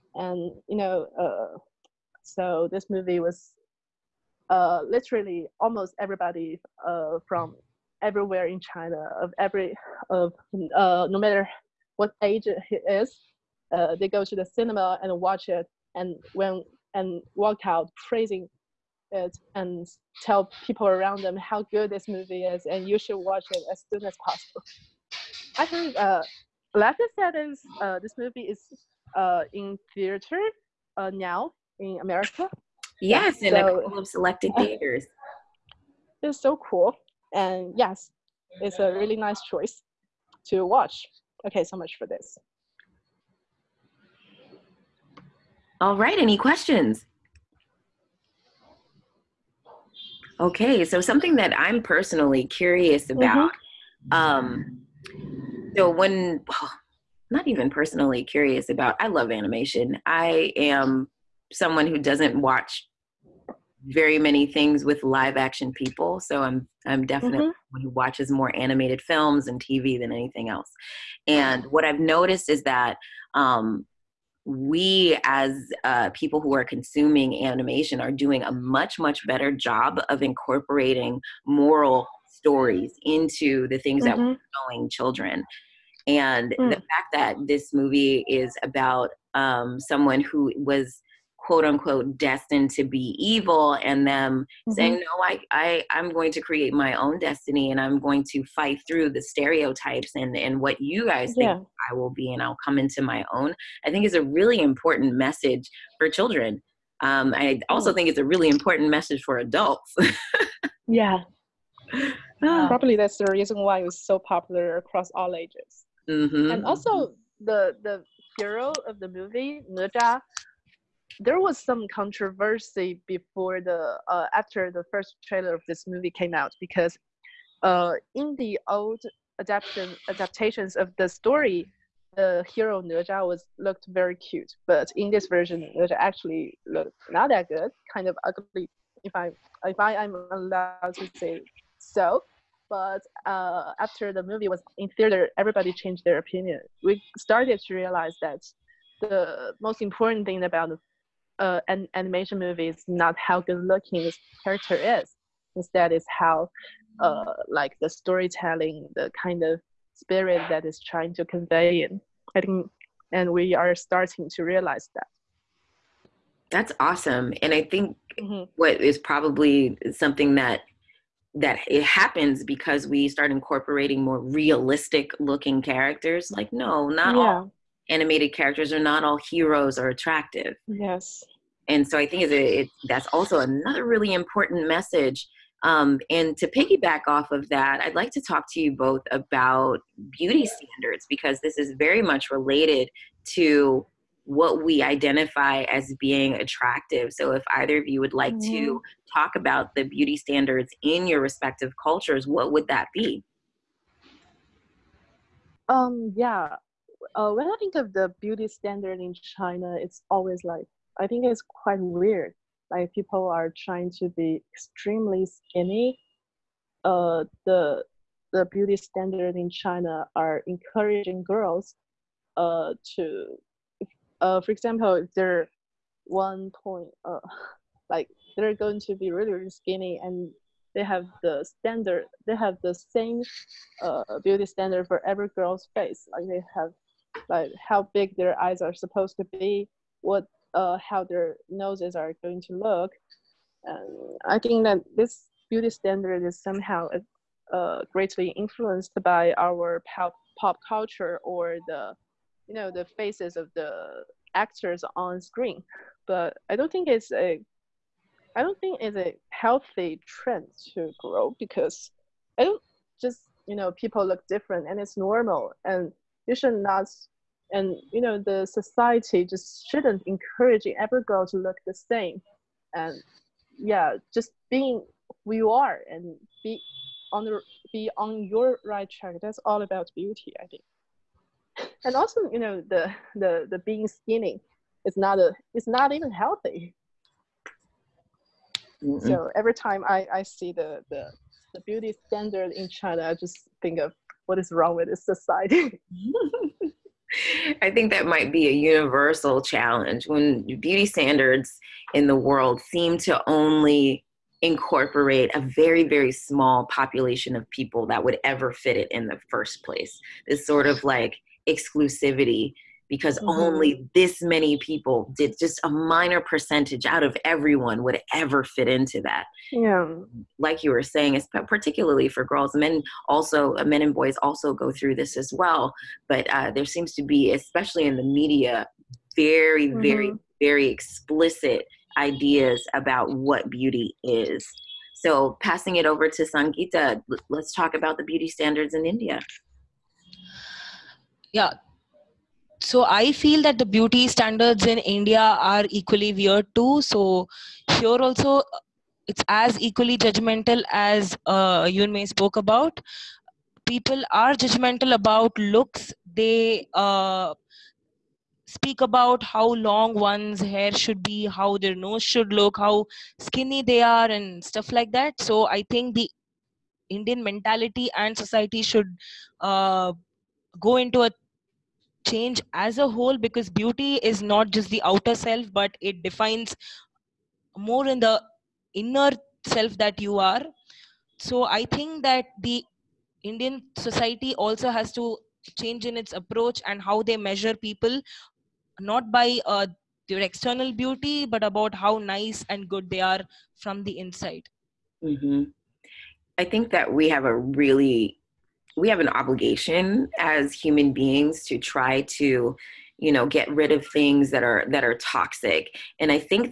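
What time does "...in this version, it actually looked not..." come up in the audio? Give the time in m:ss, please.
2:14.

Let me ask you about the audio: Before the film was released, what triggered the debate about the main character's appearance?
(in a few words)
The first trailer.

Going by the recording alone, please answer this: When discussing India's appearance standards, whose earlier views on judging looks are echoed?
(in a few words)
Yunmei.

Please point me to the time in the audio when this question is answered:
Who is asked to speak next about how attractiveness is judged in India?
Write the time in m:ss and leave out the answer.
5:36.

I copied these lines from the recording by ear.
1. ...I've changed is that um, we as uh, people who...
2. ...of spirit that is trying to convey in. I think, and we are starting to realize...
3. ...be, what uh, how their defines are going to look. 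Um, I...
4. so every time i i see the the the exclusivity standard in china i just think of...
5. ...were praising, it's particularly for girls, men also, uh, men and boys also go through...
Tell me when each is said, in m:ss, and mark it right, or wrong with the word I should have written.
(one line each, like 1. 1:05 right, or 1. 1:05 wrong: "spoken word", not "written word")
1. 1:11 wrong: "noticed", not "changed"
2. 2:39 right
3. 3:59 wrong: "noses", not "defines"
4. 4:49 wrong: "beauty", not "exclusivity"
5. 5:20 wrong: "saying", not "praising".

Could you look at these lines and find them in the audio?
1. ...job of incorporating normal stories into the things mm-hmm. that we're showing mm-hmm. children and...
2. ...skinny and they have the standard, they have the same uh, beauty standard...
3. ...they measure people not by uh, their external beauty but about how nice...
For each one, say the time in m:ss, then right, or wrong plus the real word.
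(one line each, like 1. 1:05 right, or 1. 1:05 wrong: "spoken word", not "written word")
1. 1:19 wrong: "moral", not "normal"
2. 3:49 right
3. 6:27 right.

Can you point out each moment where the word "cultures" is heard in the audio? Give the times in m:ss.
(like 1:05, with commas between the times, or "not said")
3:21, 4:10.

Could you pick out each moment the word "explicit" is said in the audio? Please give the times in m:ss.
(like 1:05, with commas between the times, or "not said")
5:30.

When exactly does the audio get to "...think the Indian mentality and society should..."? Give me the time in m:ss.
6:05.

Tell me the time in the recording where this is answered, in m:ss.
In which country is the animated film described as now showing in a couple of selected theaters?
0:32.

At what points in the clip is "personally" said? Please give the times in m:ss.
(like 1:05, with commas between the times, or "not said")
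0:51, 0:57.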